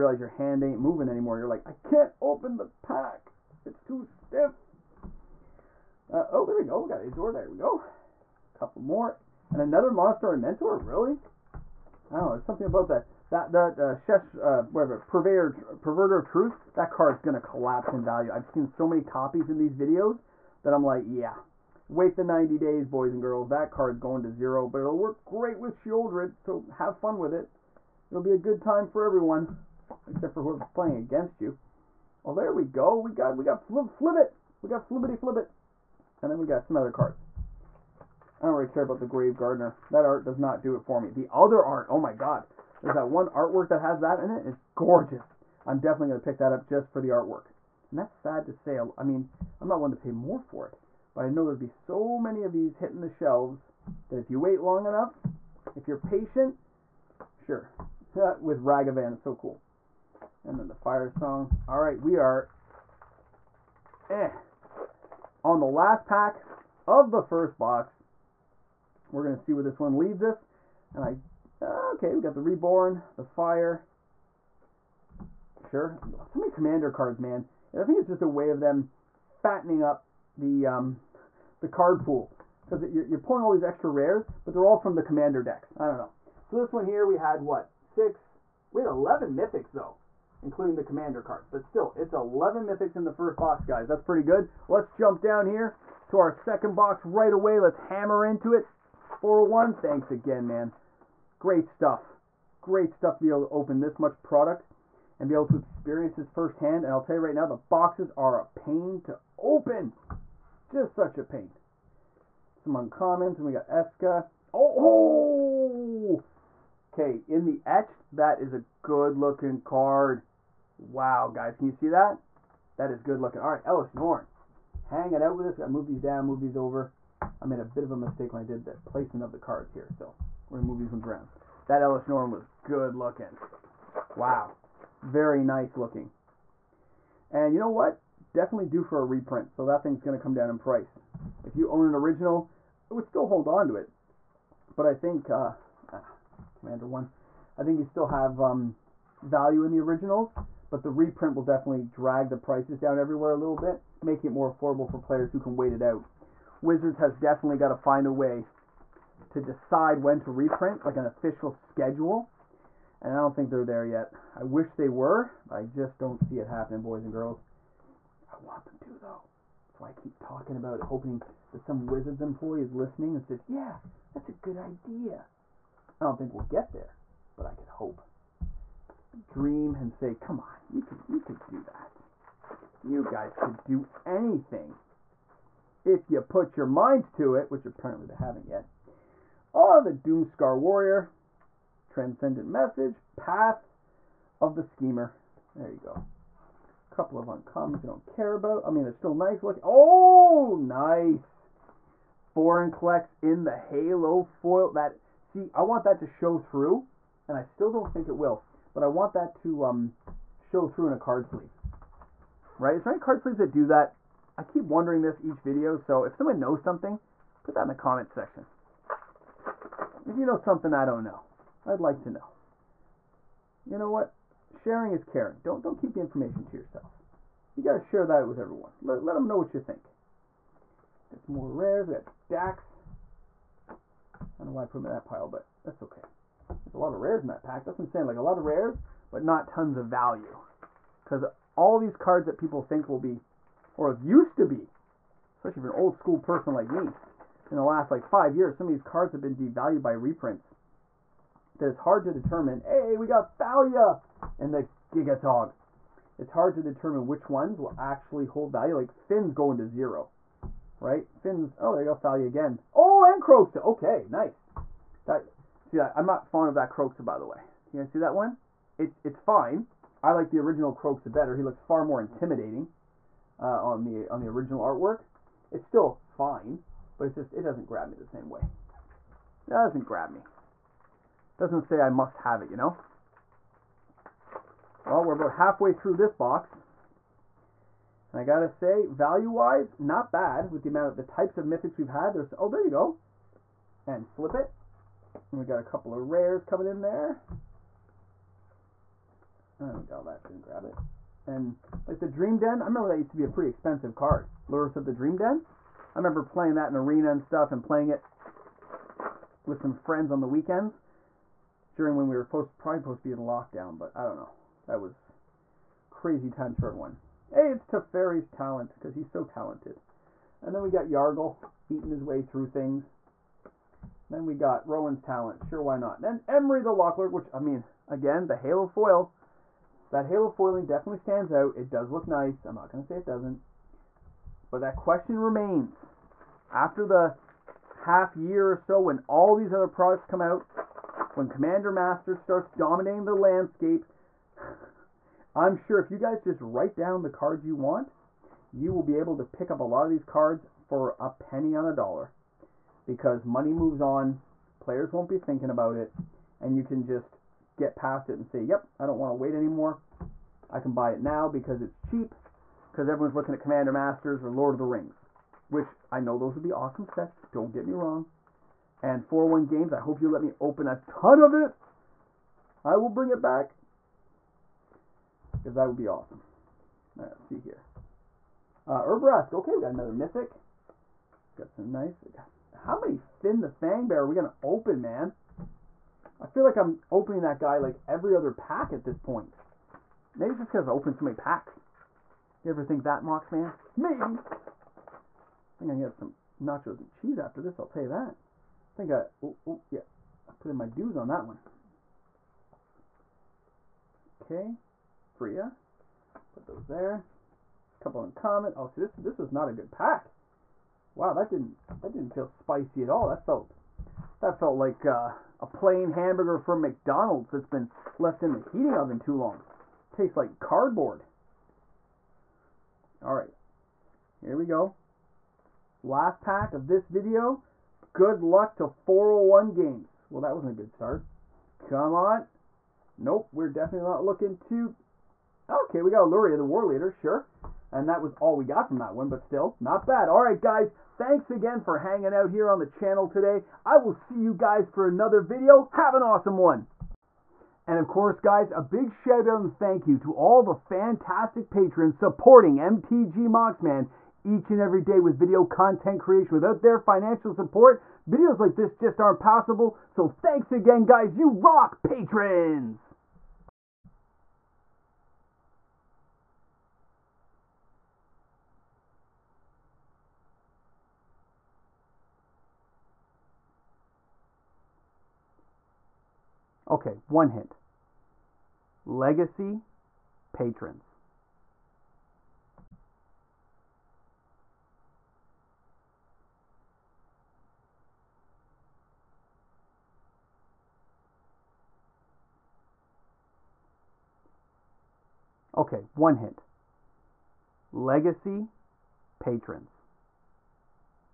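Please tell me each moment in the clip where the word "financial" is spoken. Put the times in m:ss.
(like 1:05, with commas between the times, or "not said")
7:36.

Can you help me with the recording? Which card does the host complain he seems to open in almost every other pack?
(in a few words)
Fynn the Fangbearer.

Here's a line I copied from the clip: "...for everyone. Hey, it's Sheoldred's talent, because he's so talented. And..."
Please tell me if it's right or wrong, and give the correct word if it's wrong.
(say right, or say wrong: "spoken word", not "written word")
wrong: "Teferi", not "Sheoldred".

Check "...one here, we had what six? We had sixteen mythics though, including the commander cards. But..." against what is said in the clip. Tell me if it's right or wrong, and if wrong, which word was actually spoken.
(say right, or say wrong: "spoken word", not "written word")
wrong: "eleven", not "sixteen".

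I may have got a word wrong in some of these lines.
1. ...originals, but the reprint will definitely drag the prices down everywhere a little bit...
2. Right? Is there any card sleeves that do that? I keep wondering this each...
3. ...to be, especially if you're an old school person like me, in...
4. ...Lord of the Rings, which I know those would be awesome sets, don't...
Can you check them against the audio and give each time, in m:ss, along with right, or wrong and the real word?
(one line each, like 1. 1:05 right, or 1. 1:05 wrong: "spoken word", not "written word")
1. 2:29 right
2. 3:32 right
3. 4:04 right
4. 6:04 right.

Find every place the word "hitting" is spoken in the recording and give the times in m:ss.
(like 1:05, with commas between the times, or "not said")
0:52.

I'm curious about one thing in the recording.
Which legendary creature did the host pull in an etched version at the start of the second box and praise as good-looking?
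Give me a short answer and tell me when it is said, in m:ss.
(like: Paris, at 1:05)
Eska, at 1:53.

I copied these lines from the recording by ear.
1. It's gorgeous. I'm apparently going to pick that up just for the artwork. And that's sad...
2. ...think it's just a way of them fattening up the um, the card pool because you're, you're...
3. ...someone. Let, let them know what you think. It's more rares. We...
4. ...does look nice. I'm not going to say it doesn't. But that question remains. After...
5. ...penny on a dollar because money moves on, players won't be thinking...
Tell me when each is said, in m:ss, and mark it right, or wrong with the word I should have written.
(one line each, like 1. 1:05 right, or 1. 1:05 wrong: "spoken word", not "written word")
1. 0:44 wrong: "definitely", not "apparently"
2. 1:17 right
3. 3:48 wrong: "everyone", not "someone"
4. 5:31 right
5. 5:51 right.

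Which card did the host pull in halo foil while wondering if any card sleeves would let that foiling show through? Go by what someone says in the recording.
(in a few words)
Vorinclex.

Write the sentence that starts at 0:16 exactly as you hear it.
That card's gonna collapse in value.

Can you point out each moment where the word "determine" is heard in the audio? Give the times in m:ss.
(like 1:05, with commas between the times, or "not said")
4:12, 4:16.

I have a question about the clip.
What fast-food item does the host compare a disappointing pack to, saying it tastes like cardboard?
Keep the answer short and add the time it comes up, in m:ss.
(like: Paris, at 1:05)
plain hamburger, at 6:55.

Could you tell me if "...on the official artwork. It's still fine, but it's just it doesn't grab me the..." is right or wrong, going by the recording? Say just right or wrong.
wrong.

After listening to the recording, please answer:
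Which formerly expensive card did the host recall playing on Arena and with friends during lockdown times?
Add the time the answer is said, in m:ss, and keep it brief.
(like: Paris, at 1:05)
Lurrus of the Dream Den, at 5:04.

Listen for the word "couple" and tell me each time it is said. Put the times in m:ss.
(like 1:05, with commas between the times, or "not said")
0:08, 3:16, 4:55, 6:47.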